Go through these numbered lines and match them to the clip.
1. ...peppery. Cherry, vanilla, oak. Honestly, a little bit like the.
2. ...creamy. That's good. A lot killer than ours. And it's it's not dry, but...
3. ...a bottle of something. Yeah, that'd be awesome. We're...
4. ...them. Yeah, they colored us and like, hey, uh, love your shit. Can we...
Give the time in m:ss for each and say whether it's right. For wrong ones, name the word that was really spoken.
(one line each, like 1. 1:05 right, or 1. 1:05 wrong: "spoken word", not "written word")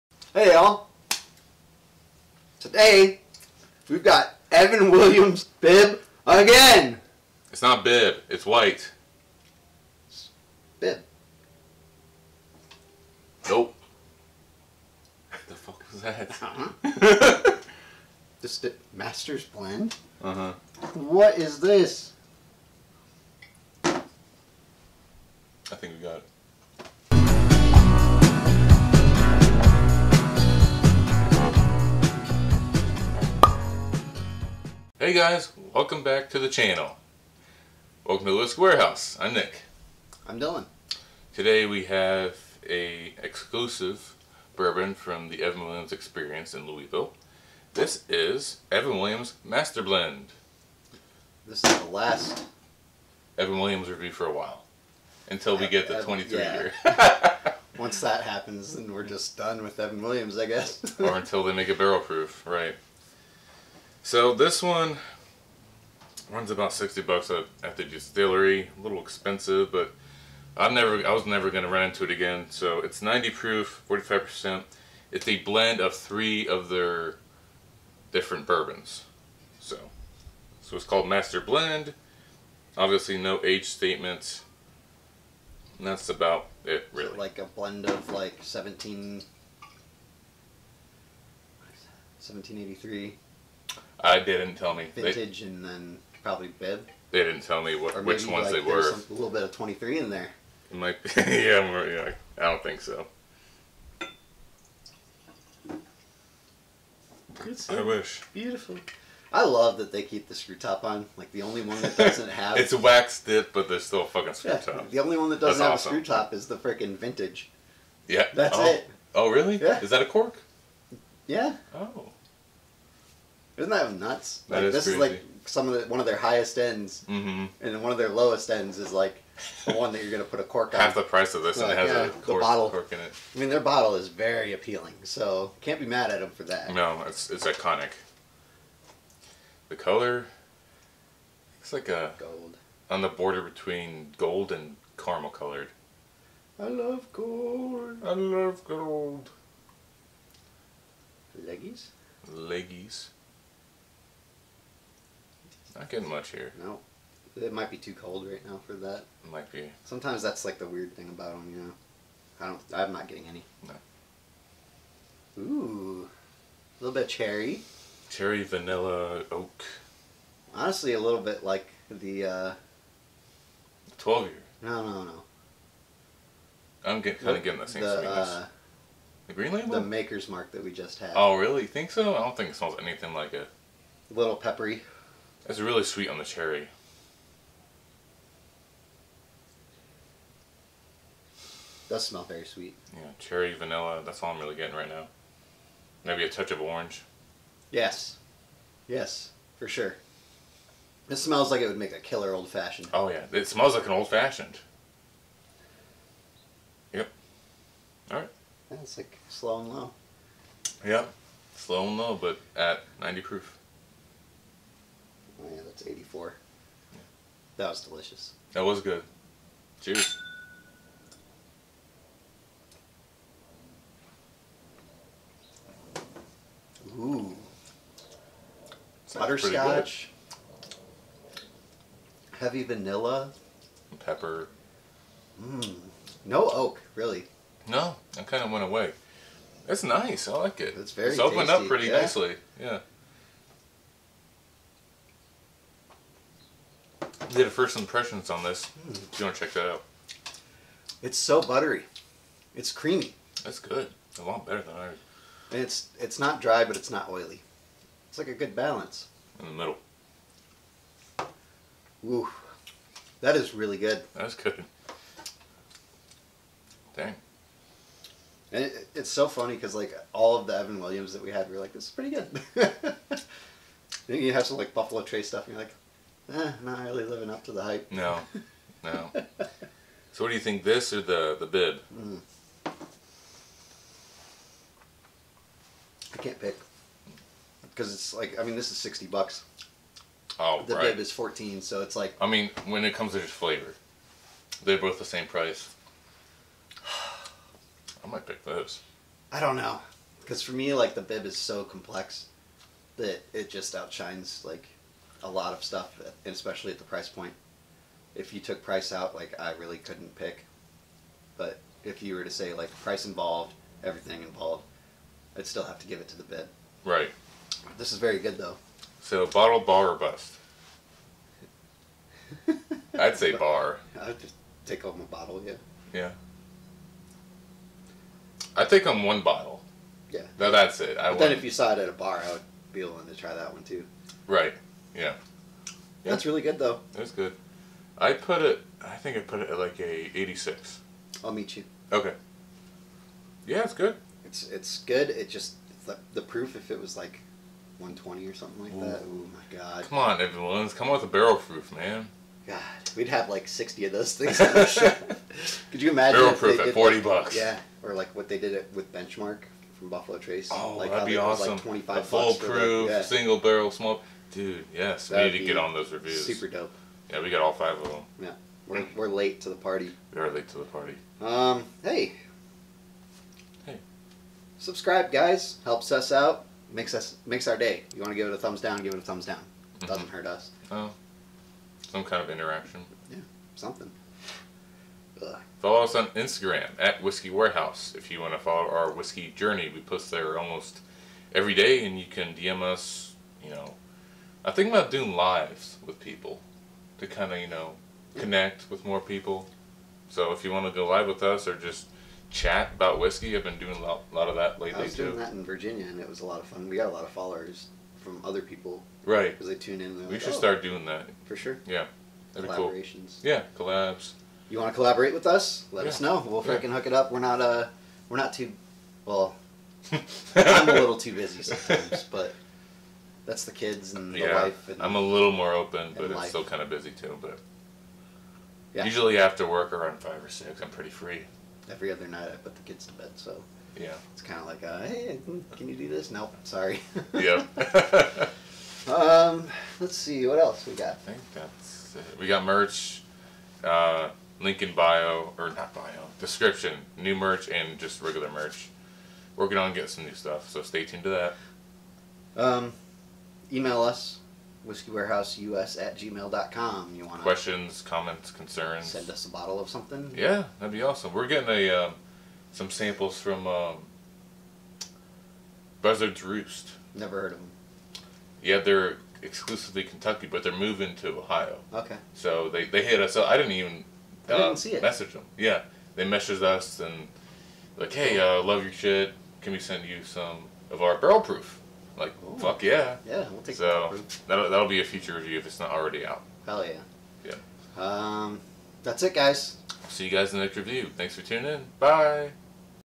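1. 2:47 wrong: "cherry", not "peppery"
2. 4:12 wrong: "better", not "killer"
3. 7:39 right
4. 7:55 wrong: "messaged", not "colored".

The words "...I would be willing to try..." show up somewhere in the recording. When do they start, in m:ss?
5:32.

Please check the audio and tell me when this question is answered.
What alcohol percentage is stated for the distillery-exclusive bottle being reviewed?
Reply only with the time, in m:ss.
1:13.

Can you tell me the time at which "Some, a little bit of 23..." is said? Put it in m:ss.
1:38.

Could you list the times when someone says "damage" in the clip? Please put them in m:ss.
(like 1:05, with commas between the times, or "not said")
not said.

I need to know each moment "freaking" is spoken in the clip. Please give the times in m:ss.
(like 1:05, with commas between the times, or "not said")
1:56, 6:56.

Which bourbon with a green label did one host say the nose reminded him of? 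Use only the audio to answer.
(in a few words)
Maker's Mark.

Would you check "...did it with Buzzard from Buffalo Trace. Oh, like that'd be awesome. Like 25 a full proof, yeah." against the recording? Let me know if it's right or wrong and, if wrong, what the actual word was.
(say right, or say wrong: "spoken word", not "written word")
wrong: "Benchmark", not "Buzzard".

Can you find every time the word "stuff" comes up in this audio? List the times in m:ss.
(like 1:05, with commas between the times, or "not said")
4:35, 5:05, 7:30.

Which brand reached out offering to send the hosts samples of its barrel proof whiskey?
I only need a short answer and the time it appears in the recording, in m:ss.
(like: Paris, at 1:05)
Buzzard's Roost, at 7:45.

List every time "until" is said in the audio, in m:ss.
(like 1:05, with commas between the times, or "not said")
0:55, 1:01.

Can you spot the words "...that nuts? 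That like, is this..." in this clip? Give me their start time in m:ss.
2:03.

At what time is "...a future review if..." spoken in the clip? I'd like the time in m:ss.
8:04.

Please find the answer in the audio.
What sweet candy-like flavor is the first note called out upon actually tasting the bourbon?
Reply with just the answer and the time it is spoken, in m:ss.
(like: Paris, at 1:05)
Butterscotch, at 3:49.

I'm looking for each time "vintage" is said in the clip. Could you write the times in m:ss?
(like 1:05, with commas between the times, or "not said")
1:34, 1:56.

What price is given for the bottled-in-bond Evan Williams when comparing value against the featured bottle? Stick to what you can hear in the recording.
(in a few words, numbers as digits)
14.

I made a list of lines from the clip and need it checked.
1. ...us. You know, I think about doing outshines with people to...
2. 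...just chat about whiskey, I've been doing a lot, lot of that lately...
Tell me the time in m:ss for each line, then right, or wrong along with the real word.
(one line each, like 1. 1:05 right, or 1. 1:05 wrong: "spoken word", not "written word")
1. 6:32 wrong: "lives", not "outshines"
2. 6:41 right.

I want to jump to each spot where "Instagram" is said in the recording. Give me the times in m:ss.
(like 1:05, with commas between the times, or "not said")
6:26.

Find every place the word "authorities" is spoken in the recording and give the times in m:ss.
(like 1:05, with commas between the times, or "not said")
not said.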